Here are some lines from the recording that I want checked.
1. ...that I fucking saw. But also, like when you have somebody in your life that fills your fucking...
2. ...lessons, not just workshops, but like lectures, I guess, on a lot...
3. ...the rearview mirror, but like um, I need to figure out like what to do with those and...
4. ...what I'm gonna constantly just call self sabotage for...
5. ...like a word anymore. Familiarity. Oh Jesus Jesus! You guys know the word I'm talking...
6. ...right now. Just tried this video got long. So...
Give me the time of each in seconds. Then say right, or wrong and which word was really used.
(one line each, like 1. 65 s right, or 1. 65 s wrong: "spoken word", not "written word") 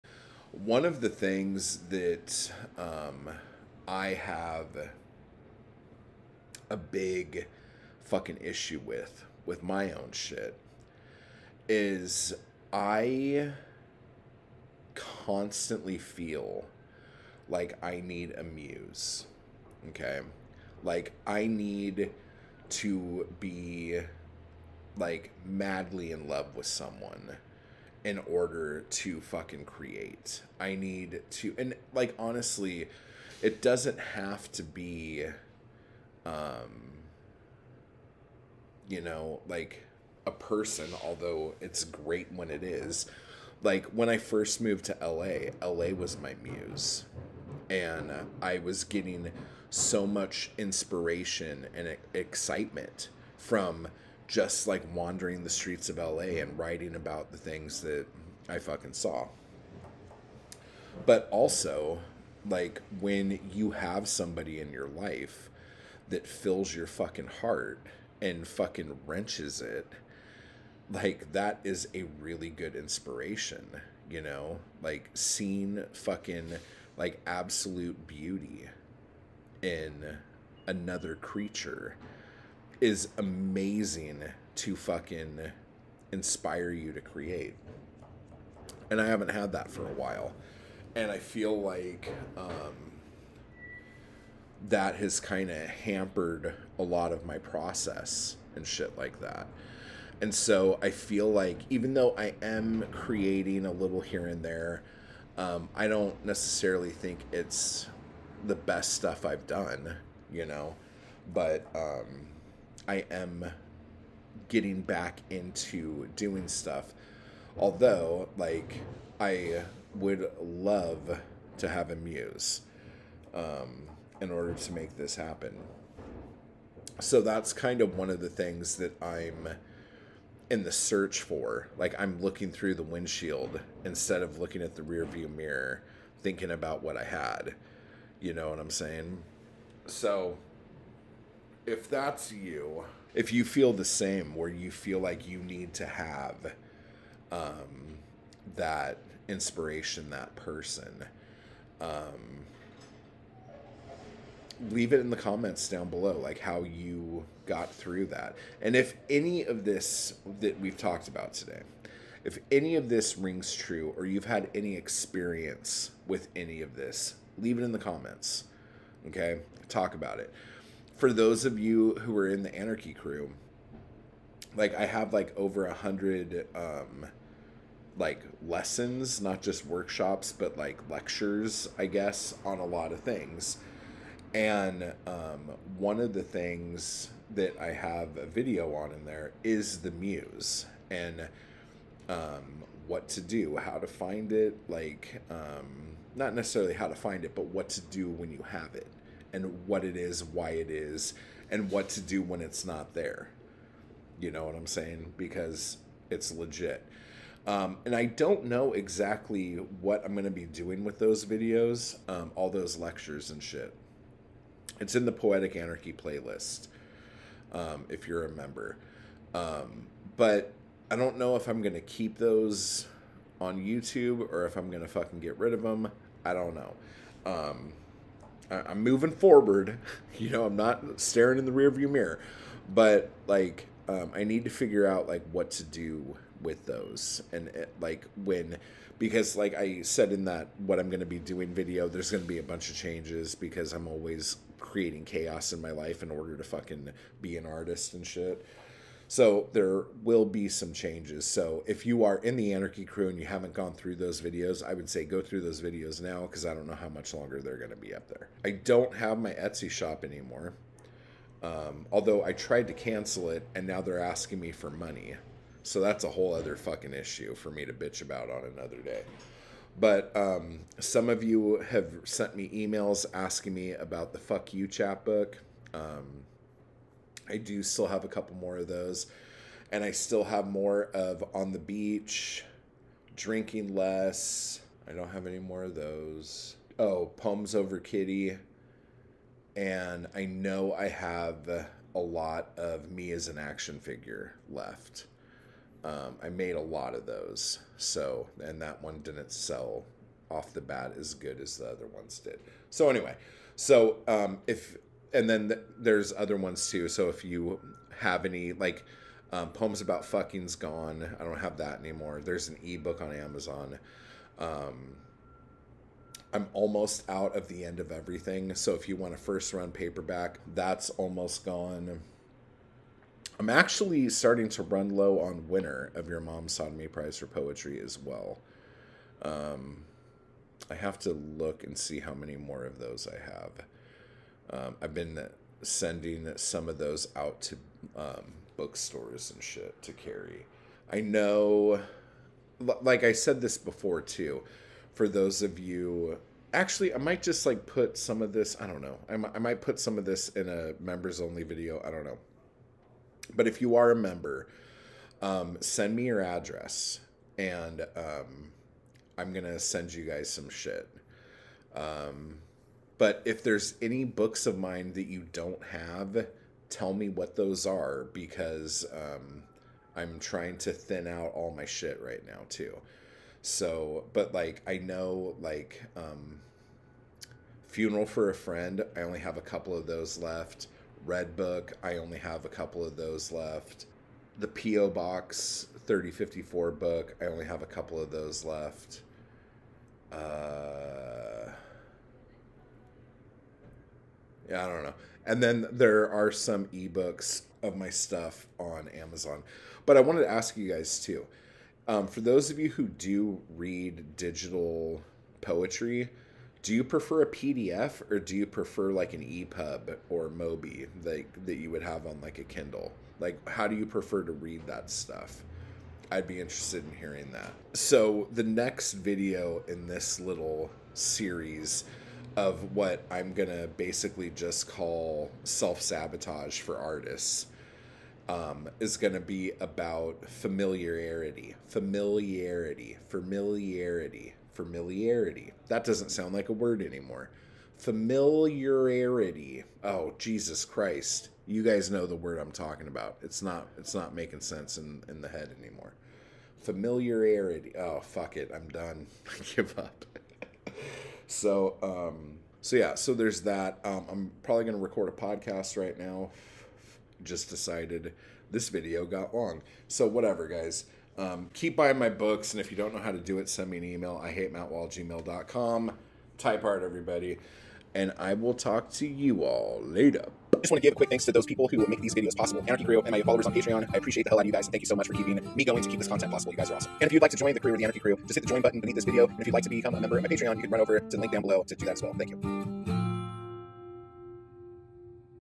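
1. 57 s right
2. 178 s right
3. 231 s right
4. 422 s wrong: "basically", not "constantly"
5. 436 s wrong: "Christ", not "Jesus"
6. 455 s wrong: "decided", not "tried".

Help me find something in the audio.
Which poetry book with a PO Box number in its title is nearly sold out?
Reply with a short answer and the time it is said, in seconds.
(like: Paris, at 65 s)
PO Box 3054, at 384 s.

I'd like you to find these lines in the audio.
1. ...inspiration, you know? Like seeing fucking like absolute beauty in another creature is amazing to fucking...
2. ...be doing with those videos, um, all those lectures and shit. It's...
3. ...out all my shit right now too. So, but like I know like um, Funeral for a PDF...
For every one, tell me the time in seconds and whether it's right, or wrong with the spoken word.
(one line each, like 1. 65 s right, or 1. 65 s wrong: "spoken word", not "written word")
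1. 72 s right
2. 210 s right
3. 371 s wrong: "Friend", not "PDF".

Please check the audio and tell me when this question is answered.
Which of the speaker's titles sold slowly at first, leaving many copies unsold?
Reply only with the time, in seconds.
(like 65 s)
292 s.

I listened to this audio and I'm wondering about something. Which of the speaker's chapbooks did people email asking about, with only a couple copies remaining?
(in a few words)
Fuck You.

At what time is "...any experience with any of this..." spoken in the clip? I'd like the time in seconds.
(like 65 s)
164 s.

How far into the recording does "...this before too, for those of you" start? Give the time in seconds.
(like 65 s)
343 s.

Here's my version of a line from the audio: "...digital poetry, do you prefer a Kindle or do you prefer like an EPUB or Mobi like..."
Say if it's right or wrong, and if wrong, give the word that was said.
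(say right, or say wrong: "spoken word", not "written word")
wrong: "PDF", not "Kindle".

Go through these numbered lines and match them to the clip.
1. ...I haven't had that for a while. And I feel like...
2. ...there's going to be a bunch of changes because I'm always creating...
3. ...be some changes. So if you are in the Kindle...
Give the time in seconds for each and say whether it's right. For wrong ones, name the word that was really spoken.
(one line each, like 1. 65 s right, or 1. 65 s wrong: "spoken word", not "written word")
1. 88 s right
2. 241 s right
3. 250 s wrong: "Anarchy", not "Kindle".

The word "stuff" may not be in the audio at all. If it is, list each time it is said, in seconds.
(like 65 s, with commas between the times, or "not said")
108 s, 116 s, 397 s, 414 s.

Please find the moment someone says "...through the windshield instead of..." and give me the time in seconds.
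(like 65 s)
132 s.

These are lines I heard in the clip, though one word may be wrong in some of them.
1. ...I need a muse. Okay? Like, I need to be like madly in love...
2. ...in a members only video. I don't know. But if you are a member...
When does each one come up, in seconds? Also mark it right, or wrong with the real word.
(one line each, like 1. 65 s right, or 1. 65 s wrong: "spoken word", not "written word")
1. 17 s right
2. 350 s right.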